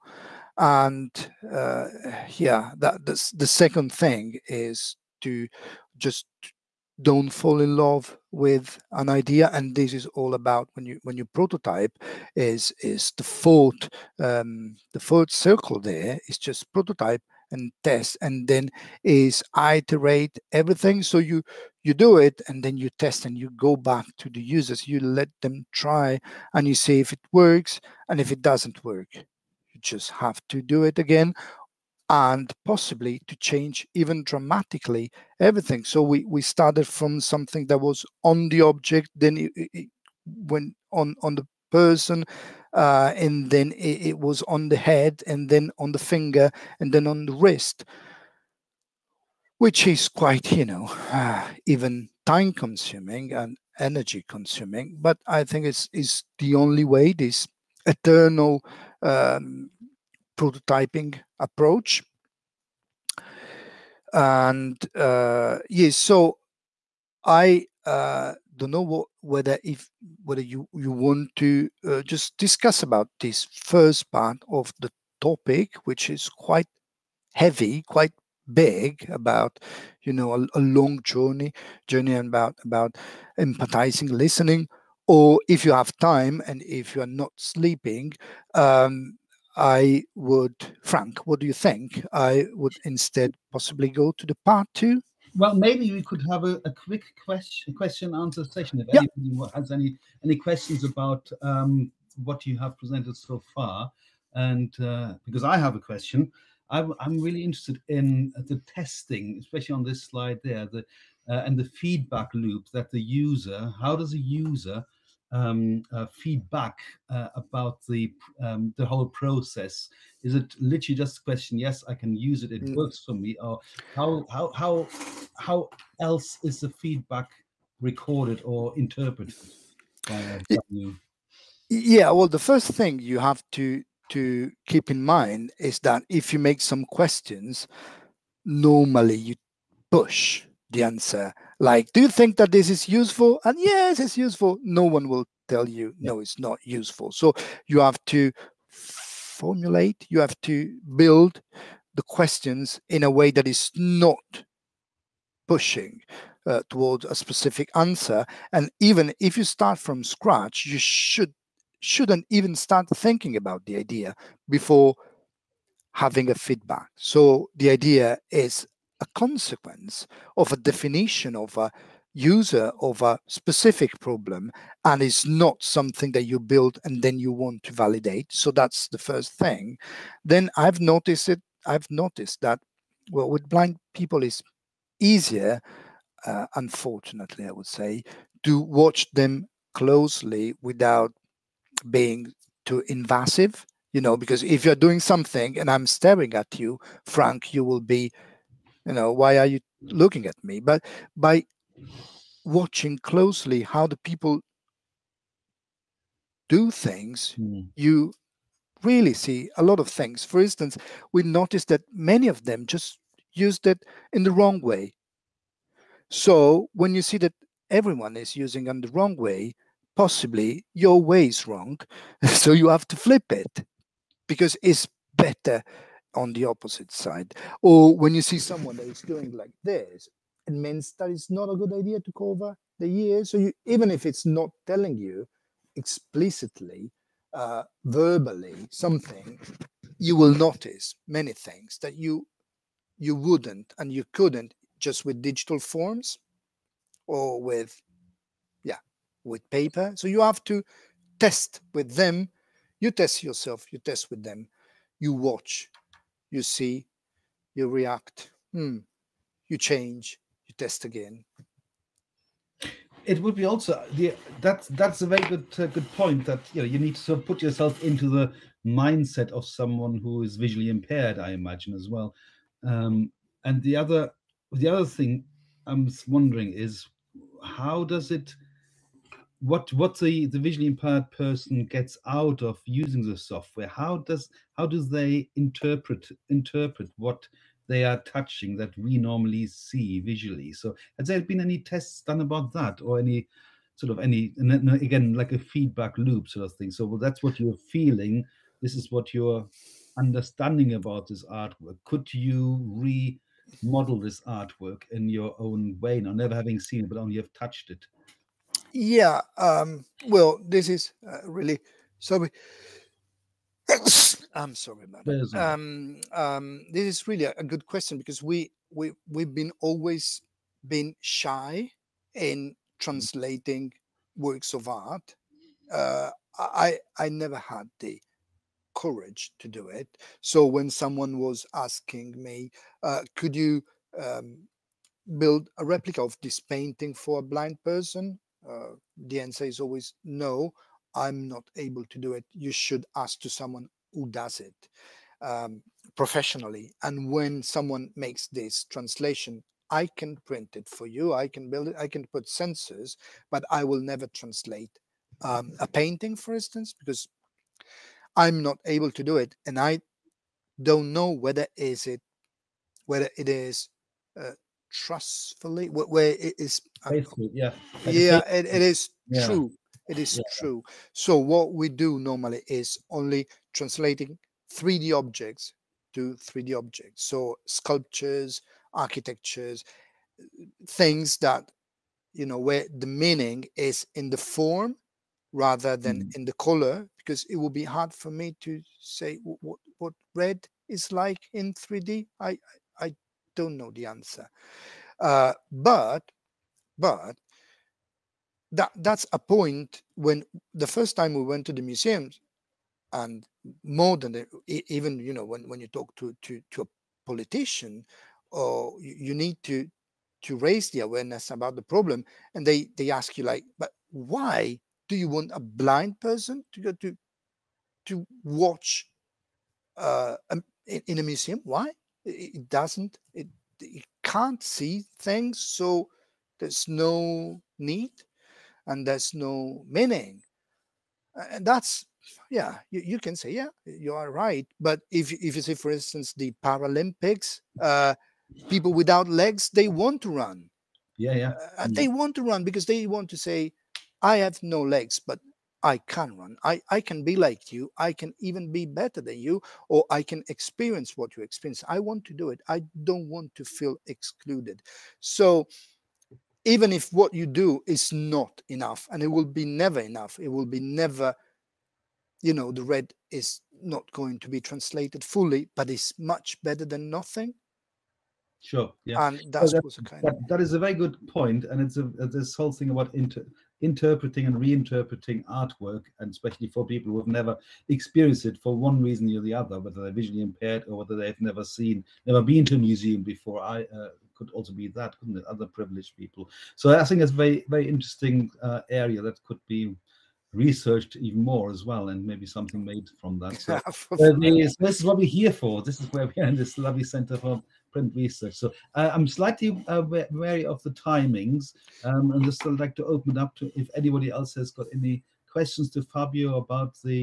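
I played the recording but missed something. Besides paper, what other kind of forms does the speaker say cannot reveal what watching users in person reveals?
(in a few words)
digital forms.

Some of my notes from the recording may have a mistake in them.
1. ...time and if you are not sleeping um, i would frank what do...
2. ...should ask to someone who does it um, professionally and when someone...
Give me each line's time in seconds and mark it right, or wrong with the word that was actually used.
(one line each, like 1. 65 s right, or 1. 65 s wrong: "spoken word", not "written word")
1. 85 s right
2. 342 s right.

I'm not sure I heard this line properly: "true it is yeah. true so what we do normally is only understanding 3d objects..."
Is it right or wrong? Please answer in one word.
wrong.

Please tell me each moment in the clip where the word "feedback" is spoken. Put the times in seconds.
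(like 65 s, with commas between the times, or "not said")
111 s, 116 s, 126 s, 166 s, 295 s.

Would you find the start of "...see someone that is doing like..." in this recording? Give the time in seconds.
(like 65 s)
228 s.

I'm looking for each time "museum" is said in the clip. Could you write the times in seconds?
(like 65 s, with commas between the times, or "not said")
401 s, 421 s, 482 s.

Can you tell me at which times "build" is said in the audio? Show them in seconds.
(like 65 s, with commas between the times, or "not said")
150 s, 176 s, 335 s, 351 s.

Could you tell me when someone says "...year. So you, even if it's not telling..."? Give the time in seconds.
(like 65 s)
232 s.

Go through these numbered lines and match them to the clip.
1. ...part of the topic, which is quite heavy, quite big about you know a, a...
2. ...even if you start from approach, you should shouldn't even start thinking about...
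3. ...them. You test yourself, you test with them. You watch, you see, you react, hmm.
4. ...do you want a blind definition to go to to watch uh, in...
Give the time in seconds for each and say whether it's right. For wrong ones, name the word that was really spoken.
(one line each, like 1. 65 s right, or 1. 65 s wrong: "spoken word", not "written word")
1. 74 s right
2. 158 s wrong: "scratch", not "approach"
3. 251 s right
4. 414 s wrong: "person", not "definition".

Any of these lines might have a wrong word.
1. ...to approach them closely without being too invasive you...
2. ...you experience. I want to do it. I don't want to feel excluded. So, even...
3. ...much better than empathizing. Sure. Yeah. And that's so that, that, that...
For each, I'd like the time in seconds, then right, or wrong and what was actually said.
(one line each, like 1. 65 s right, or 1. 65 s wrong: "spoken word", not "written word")
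1. 188 s wrong: "watch", not "approach"
2. 451 s right
3. 465 s wrong: "nothing", not "empathizing".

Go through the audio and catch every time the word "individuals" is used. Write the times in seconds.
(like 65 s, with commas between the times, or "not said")
not said.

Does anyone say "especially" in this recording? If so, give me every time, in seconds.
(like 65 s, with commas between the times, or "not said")
109 s, 476 s.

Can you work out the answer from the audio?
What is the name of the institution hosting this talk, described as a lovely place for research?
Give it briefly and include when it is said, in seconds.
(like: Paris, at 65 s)
Center for Print Research, at 496 s.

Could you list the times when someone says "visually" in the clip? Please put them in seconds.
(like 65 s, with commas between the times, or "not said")
270 s, 280 s, 289 s, 479 s.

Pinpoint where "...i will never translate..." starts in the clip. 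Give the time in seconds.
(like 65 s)
353 s.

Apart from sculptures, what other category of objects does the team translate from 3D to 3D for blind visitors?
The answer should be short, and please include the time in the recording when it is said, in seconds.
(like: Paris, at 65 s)
architectures, at 378 s.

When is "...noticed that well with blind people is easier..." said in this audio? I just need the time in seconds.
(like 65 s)
181 s.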